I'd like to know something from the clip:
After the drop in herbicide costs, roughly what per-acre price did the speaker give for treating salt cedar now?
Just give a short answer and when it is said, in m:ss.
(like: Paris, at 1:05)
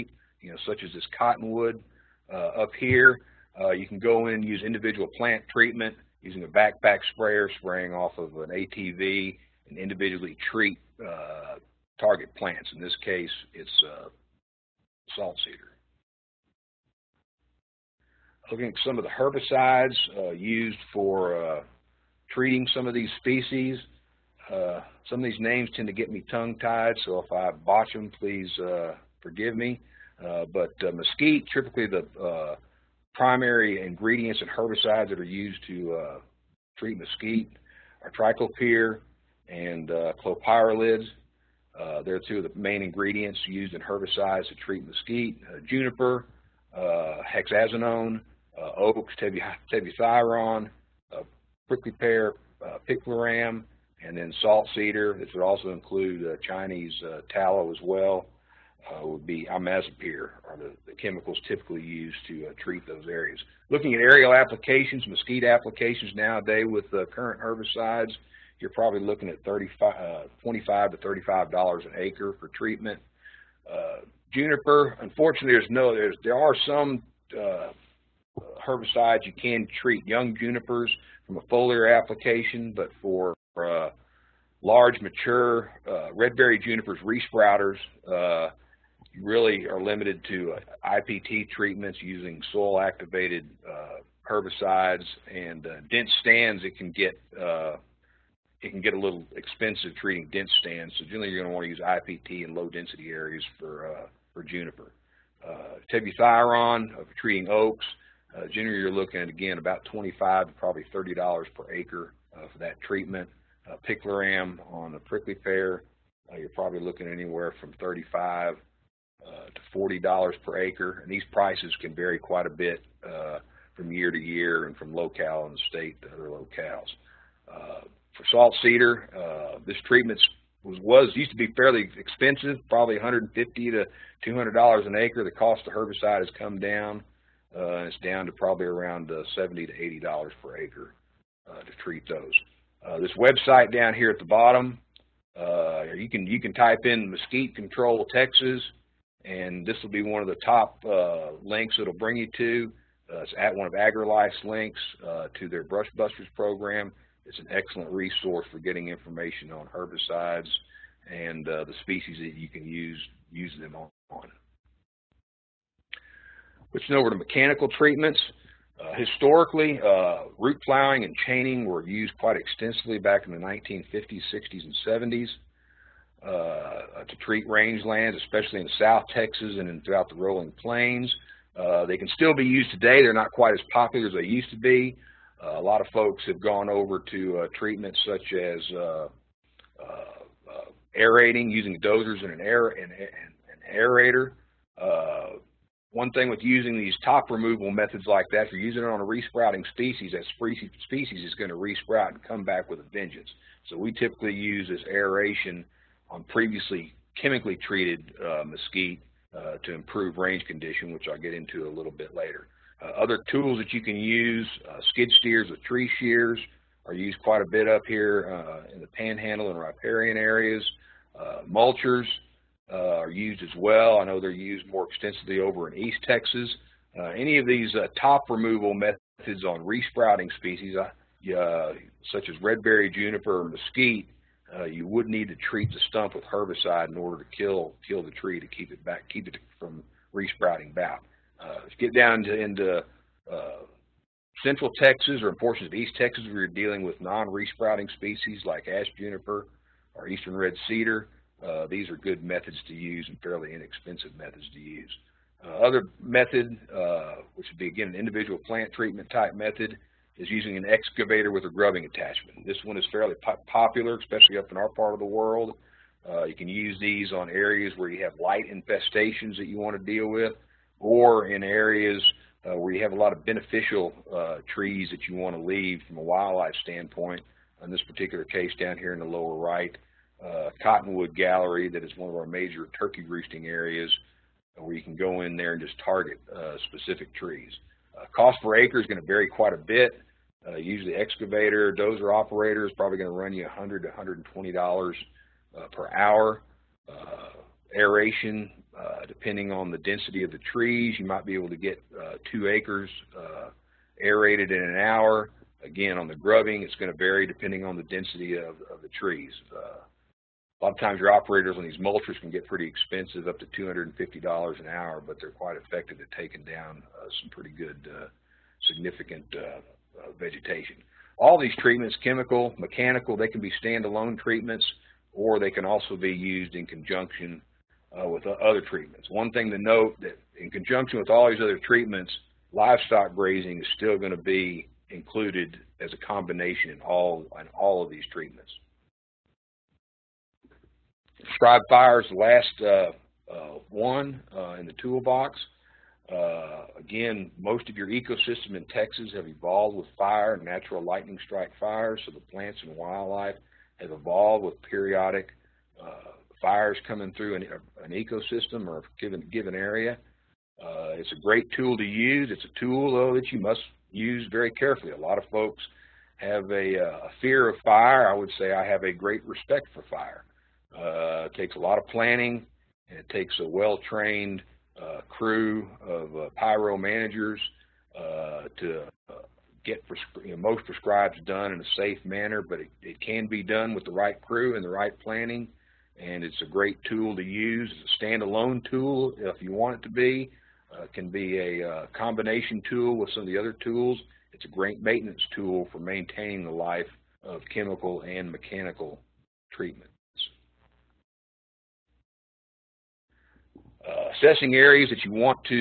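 $70 to $80 per acre, at 2:19.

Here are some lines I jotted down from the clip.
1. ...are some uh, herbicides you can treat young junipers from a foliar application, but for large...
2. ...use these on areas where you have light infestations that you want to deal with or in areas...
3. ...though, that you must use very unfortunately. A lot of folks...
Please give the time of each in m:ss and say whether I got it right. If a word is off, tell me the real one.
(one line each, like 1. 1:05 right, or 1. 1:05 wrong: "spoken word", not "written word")
1. 1:16 right
2. 4:26 right
3. 6:02 wrong: "carefully", not "unfortunately".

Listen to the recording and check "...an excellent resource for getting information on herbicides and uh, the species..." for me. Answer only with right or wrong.
right.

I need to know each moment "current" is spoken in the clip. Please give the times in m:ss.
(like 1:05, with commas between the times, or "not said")
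1:07.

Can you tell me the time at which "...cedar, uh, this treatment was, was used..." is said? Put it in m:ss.
2:08.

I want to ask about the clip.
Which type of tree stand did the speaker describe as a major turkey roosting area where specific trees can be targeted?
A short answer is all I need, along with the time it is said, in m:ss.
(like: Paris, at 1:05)
Cottonwood gallery, at 4:40.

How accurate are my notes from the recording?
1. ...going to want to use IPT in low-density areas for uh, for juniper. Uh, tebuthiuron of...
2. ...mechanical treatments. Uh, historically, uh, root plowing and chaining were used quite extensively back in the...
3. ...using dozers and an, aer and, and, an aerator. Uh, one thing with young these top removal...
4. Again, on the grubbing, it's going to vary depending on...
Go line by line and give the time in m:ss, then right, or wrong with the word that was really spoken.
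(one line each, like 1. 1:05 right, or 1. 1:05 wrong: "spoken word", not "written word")
1. 1:41 right
2. 2:47 right
3. 3:11 wrong: "using", not "young"
4. 5:05 right.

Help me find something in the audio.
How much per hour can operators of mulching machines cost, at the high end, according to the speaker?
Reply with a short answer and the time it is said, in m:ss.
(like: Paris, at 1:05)
$250 an hour, at 5:13.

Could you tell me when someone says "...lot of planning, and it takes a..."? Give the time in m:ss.
6:11.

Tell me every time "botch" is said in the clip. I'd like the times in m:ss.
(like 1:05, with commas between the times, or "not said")
0:27.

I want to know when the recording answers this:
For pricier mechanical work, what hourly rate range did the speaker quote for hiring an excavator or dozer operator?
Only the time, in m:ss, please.
4:53.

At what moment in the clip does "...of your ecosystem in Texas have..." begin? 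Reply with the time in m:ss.
5:47.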